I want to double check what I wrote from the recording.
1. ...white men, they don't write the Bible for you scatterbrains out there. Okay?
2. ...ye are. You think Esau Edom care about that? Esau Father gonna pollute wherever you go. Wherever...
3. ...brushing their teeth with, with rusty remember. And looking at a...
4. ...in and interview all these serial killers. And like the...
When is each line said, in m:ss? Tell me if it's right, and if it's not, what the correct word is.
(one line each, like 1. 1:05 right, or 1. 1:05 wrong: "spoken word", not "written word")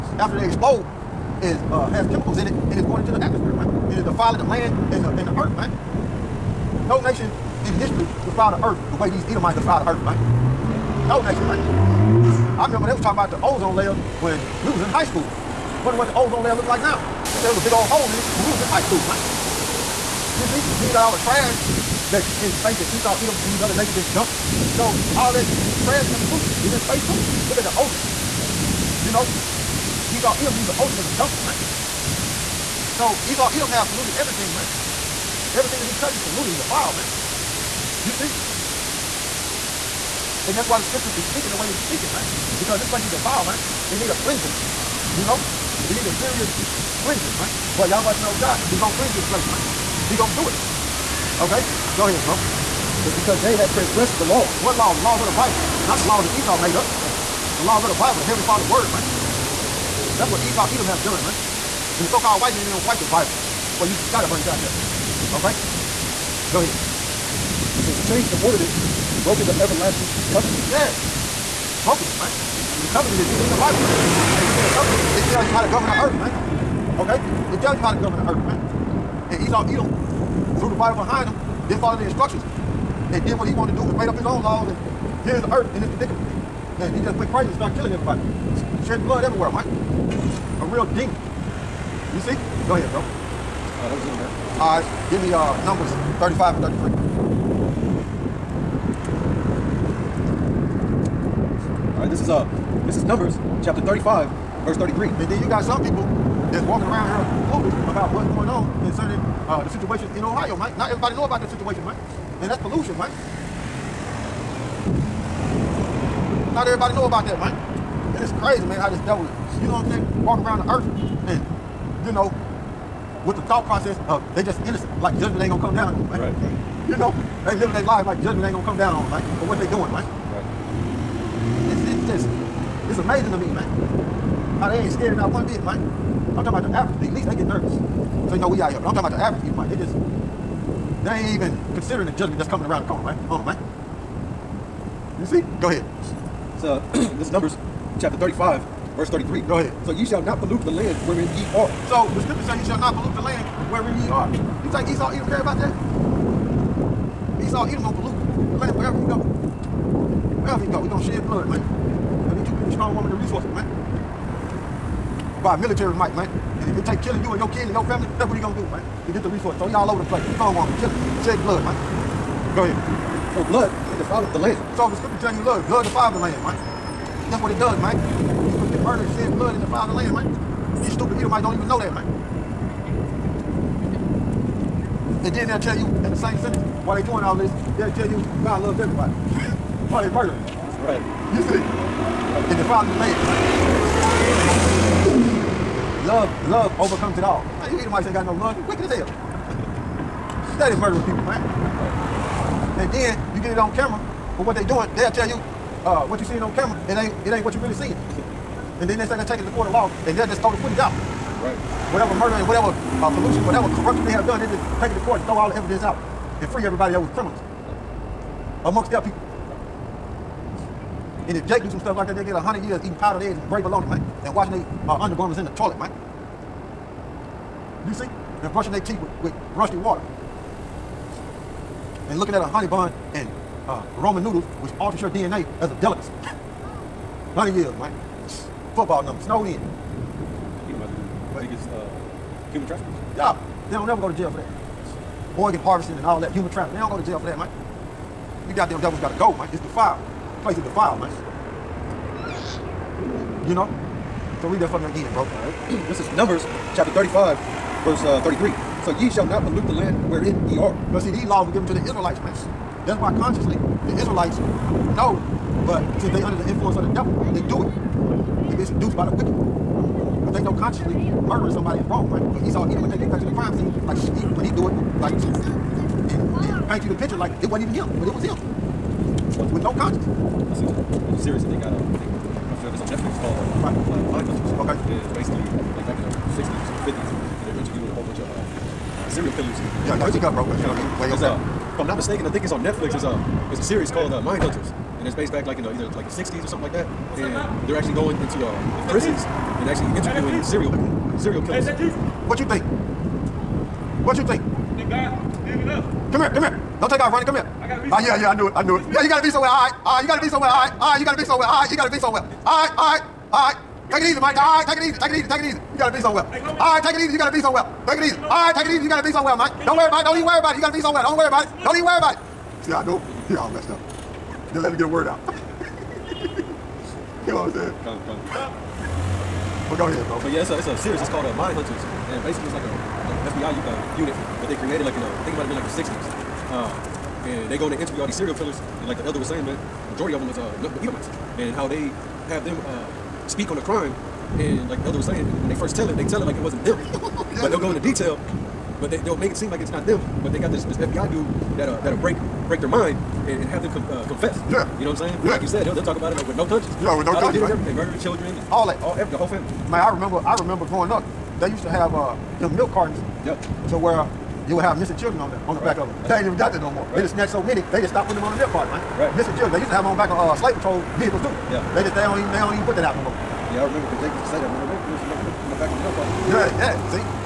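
1. 1:02 right
2. 2:34 wrong: "Edom", not "Father"
3. 3:48 wrong: "water", not "remember"
4. 5:37 right.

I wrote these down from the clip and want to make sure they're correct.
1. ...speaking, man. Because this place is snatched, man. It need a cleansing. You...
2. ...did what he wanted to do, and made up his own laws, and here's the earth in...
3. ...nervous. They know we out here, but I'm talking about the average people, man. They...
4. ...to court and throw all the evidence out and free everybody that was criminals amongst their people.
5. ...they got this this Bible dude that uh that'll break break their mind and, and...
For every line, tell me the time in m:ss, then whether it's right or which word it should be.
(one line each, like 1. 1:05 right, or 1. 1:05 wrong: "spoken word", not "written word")
1. 0:41 wrong: "defiled", not "snatched"
2. 1:23 right
3. 2:17 right
4. 3:34 right
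5. 5:50 wrong: "FBI", not "Bible".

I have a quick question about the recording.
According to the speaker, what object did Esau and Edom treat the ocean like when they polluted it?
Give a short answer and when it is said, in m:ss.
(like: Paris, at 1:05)
a dumpster, at 0:31.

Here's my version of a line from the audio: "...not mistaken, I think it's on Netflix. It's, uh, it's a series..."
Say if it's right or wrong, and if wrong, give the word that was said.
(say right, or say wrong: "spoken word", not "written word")
right.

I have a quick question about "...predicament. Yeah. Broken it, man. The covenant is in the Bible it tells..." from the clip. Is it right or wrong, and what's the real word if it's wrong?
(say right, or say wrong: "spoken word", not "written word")
wrong: "covenant", not "predicament".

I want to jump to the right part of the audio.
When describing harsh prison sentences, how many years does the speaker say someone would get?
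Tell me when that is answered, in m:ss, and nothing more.
3:42.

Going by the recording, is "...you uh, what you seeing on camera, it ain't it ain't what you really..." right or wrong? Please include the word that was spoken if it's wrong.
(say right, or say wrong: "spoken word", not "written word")
right.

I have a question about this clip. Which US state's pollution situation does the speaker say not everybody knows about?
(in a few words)
Ohio.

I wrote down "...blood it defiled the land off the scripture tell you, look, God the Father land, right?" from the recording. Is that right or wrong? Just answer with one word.
right.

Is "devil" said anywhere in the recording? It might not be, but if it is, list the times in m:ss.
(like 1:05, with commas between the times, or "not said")
1:59, 4:08, 4:26.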